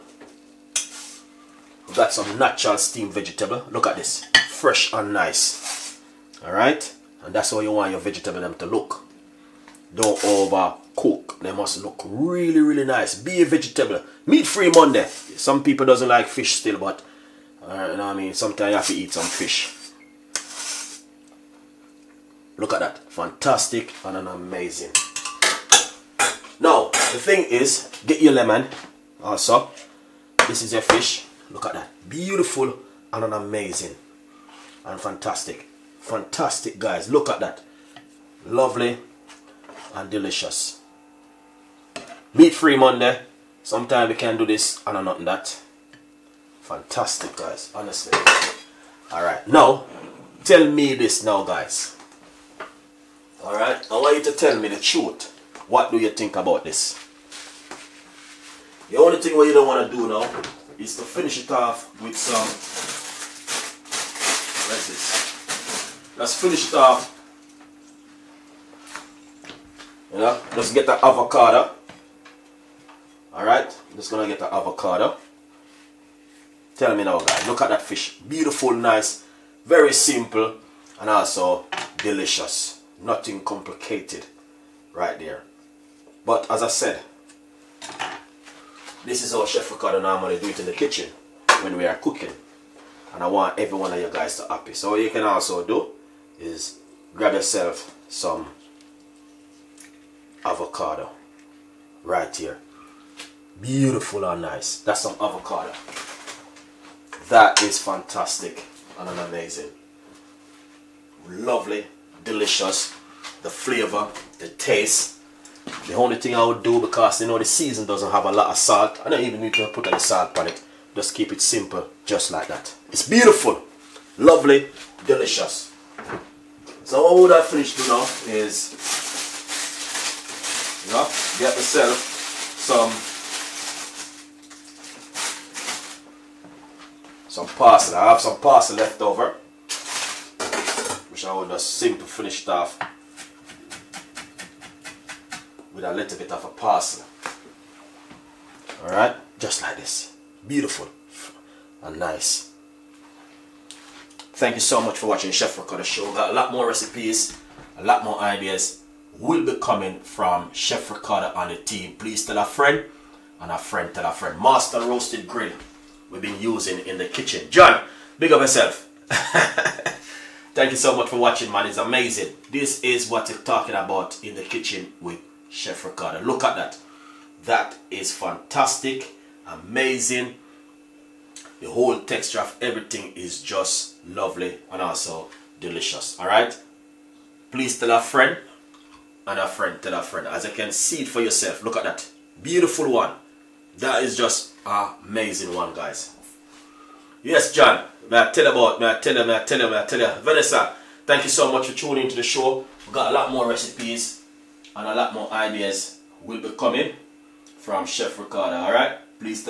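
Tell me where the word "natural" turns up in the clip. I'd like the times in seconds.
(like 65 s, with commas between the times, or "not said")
2 s.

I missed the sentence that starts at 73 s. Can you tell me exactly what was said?
Alright, just gonna get the avocado.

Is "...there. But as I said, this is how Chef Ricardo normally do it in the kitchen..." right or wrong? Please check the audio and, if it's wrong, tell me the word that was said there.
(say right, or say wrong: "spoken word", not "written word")
right.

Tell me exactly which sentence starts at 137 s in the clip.
I have some parsley left over, which I will just simply finish off with a little bit of a parsley.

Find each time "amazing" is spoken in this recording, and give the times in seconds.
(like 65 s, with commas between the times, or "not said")
24 s, 33 s, 109 s, 171 s, 179 s, 195 s.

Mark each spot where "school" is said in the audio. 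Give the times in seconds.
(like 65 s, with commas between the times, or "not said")
not said.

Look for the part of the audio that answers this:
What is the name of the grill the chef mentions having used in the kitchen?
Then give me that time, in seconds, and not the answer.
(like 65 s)
164 s.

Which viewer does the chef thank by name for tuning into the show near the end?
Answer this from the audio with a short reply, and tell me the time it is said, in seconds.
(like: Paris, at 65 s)
Vanessa, at 200 s.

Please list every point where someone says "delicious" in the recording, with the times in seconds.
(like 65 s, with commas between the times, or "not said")
40 s, 81 s, 112 s, 125 s, 185 s.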